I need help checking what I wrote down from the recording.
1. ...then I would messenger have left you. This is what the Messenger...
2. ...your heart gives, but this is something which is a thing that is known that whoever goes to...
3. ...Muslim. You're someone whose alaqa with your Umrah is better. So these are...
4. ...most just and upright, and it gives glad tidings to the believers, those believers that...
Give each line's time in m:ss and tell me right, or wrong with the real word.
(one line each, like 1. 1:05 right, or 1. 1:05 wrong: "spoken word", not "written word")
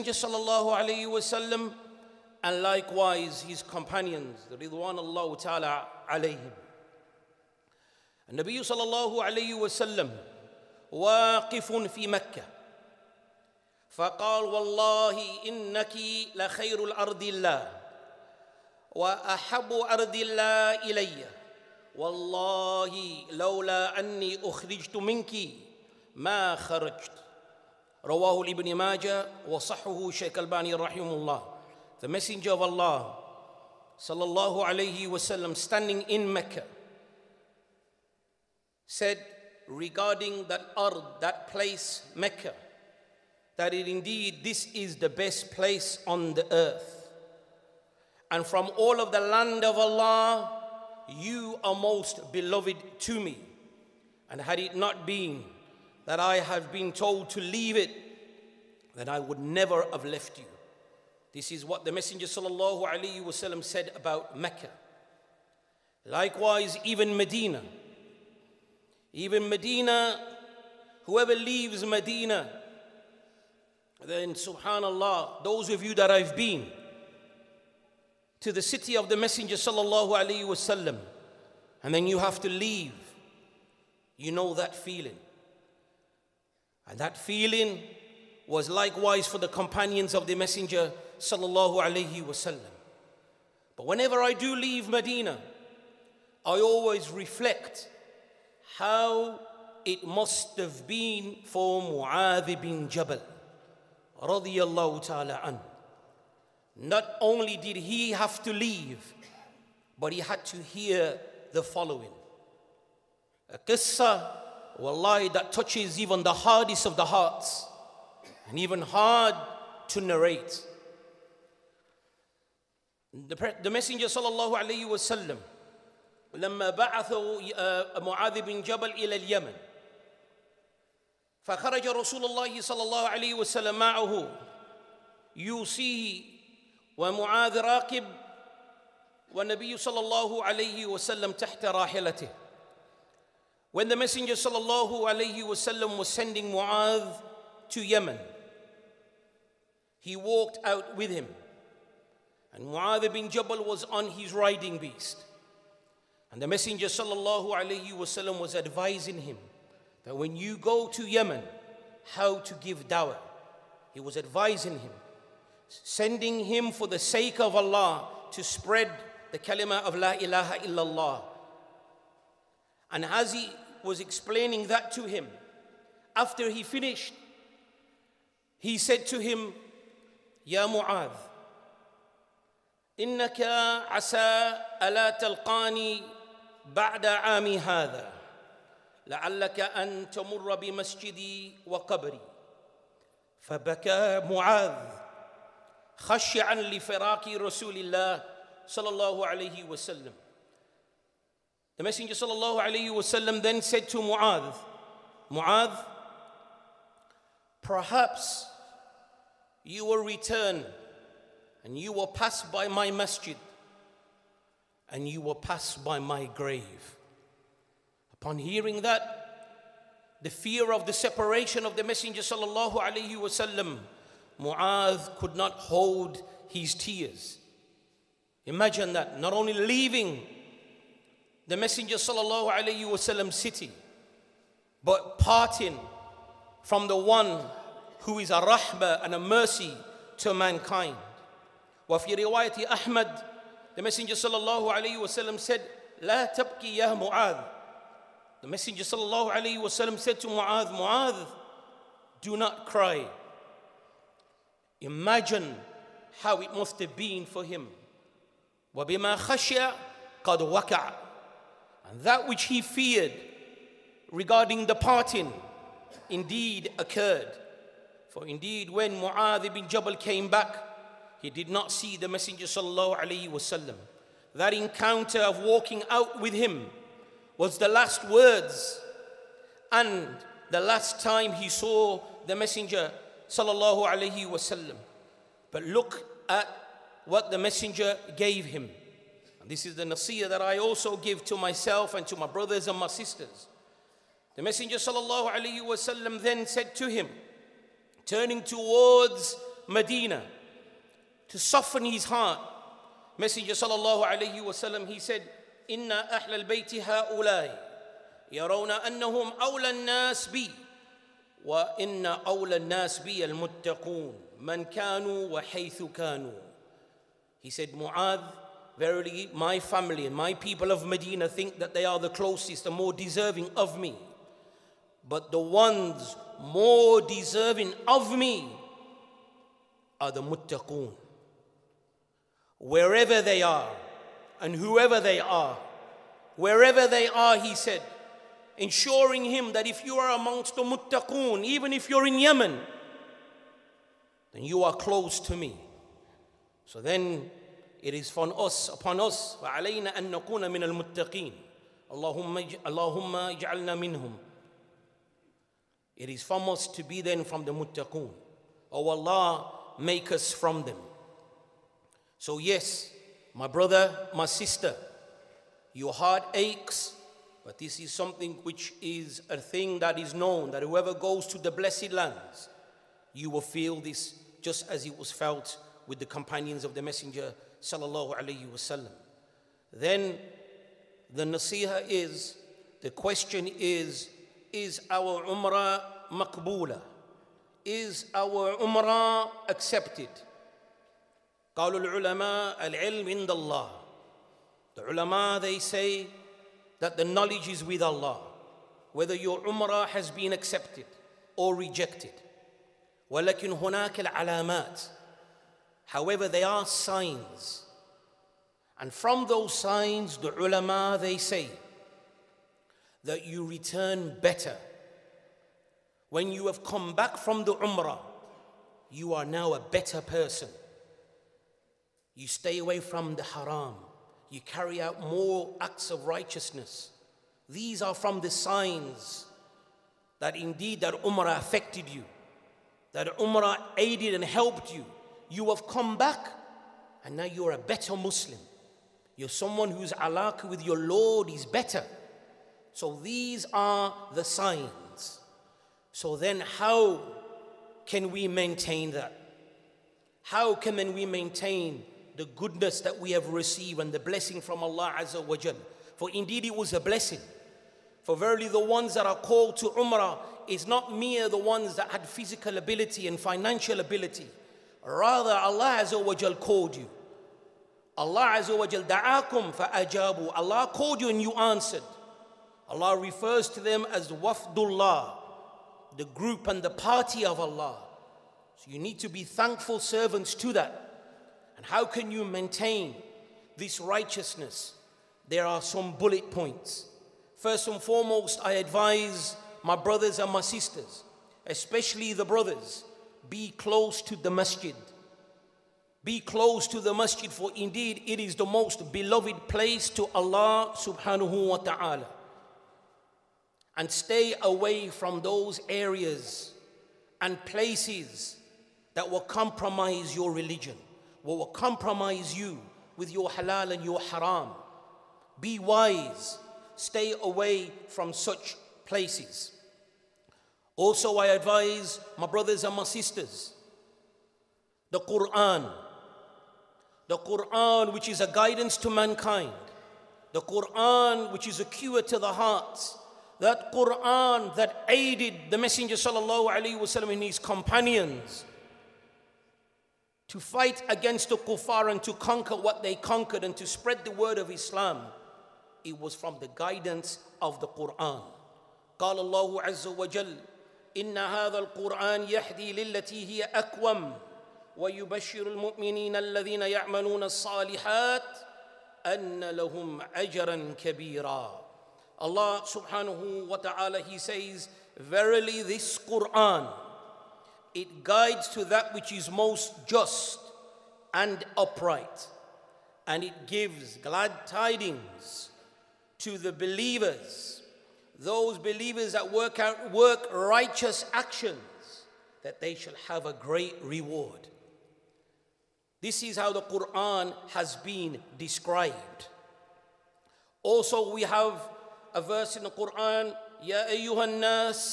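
1. 0:58 wrong: "never", not "messenger"
2. 6:05 wrong: "aches", not "gives"
3. 7:17 wrong: "Lord", not "Umrah"
4. 9:29 right.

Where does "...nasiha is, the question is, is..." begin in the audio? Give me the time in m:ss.
6:21.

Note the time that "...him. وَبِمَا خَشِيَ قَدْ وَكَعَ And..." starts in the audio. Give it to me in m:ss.
4:17.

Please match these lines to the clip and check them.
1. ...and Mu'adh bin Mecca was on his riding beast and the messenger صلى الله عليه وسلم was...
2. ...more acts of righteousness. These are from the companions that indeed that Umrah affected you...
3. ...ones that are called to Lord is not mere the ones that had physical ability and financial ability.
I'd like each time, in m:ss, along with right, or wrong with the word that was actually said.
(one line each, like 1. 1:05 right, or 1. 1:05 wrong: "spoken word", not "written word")
1. 2:32 wrong: "Jabal", not "Mecca"
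2. 7:04 wrong: "signs", not "companions"
3. 7:38 wrong: "Umrah", not "Lord".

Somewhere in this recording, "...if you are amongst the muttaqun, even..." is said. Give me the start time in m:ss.
5:39.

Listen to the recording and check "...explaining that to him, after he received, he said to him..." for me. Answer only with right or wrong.
wrong.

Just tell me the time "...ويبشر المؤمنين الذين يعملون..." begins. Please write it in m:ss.
9:14.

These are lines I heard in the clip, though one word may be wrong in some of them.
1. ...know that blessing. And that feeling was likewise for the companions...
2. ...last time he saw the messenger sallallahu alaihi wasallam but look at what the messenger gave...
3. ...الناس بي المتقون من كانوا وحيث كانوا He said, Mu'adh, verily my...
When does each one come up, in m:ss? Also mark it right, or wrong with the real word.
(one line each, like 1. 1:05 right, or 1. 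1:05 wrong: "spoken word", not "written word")
1. 1:24 wrong: "feeling", not "blessing"
2. 4:40 right
3. 5:12 right.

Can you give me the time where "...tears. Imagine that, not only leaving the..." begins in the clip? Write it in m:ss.
3:46.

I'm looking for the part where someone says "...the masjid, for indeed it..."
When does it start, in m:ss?
8:16.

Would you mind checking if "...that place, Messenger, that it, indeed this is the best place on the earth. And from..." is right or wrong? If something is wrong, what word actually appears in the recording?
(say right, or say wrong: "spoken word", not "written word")
wrong: "Mecca", not "Messenger".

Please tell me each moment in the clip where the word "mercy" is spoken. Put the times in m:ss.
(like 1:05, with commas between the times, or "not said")
3:59.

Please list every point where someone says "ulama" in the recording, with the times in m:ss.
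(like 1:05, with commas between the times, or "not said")
6:34, 6:50.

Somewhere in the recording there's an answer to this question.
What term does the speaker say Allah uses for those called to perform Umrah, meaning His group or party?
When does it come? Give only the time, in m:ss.
7:54.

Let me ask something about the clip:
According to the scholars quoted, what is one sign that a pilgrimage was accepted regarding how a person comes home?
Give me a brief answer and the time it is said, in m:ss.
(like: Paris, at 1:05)
return better, at 6:53.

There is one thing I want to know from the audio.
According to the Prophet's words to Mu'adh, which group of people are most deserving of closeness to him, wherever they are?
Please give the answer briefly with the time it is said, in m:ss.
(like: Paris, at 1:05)
the muttaqoon, at 5:30.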